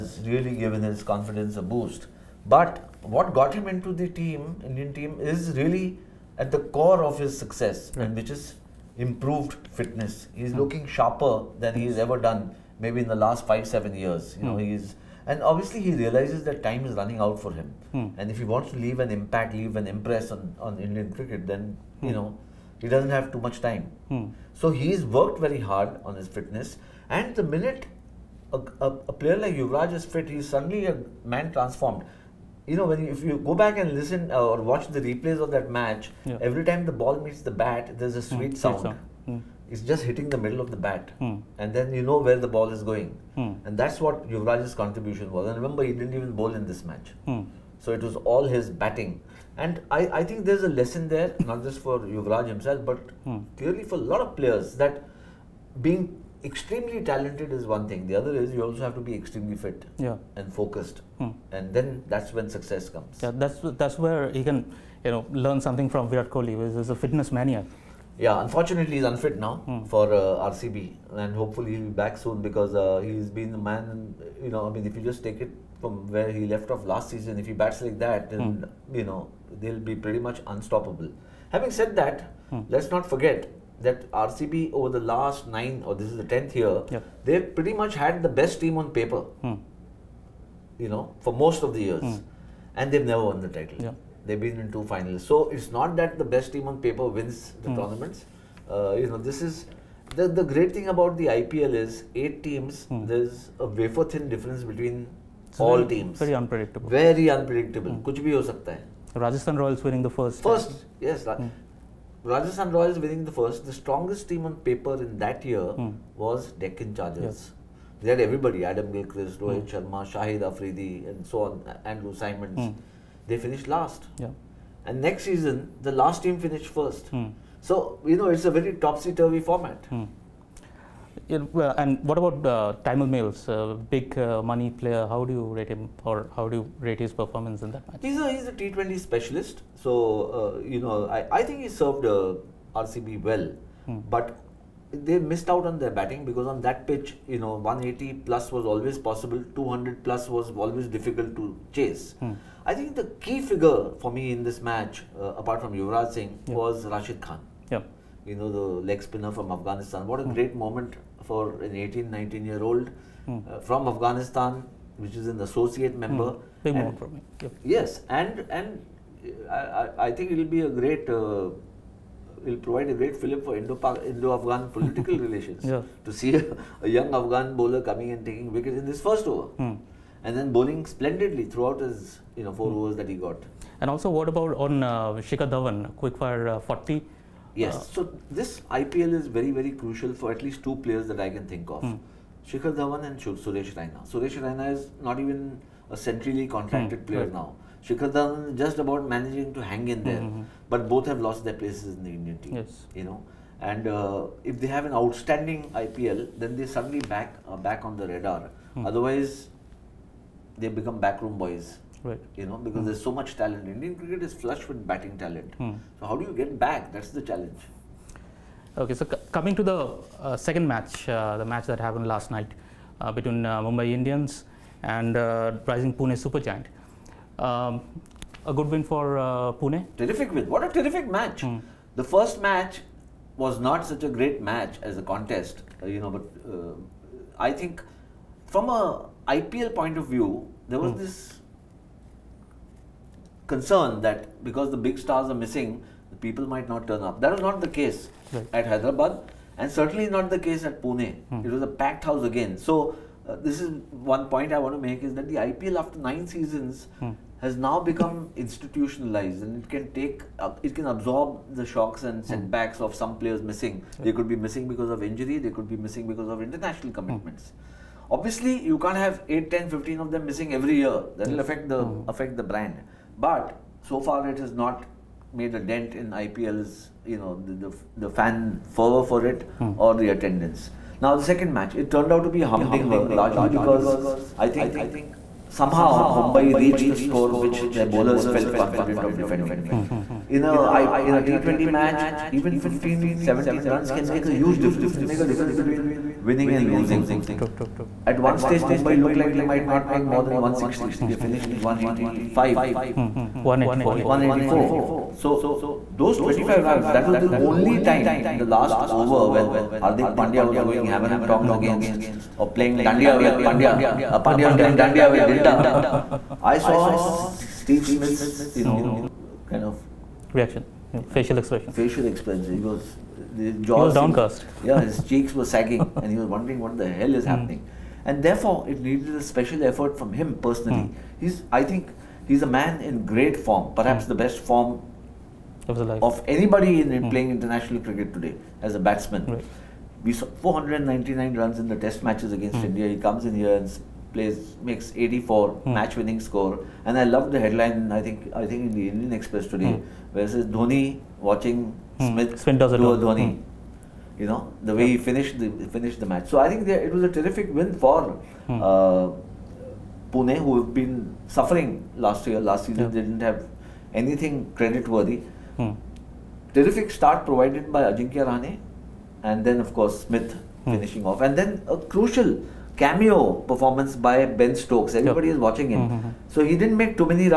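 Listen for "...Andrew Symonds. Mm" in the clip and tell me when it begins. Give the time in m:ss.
2:01.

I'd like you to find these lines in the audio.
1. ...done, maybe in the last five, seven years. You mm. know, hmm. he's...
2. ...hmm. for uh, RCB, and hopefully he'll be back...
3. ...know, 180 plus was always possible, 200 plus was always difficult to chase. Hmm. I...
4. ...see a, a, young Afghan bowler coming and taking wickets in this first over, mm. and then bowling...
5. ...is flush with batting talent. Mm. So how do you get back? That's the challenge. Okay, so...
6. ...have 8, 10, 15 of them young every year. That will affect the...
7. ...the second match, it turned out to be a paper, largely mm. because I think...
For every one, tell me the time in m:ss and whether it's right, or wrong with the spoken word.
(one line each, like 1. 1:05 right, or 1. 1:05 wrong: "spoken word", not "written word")
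1. 0:12 right
2. 1:09 right
3. 2:27 right
4. 2:56 right
5. 3:34 right
6. 4:28 wrong: "missing", not "young"
7. 4:41 wrong: "humdinger", not "paper".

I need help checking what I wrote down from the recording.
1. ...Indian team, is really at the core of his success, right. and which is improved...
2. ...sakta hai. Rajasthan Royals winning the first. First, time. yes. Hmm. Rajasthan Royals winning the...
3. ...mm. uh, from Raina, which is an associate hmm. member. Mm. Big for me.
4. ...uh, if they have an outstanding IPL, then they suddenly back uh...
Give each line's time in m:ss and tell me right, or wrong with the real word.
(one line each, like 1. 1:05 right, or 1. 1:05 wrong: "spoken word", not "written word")
1. 0:04 right
2. 1:48 right
3. 2:43 wrong: "Afghanistan", not "Raina"
4. 3:23 right.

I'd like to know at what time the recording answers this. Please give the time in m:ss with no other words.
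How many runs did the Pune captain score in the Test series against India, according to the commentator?
5:40.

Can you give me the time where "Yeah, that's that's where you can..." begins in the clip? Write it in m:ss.
1:03.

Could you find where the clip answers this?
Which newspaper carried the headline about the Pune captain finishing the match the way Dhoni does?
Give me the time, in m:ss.
5:48.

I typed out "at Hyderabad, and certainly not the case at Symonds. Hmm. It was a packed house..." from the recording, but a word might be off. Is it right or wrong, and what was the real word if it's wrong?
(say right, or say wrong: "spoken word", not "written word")
wrong: "Pune", not "Symonds".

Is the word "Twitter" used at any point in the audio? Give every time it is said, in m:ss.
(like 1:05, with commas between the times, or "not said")
not said.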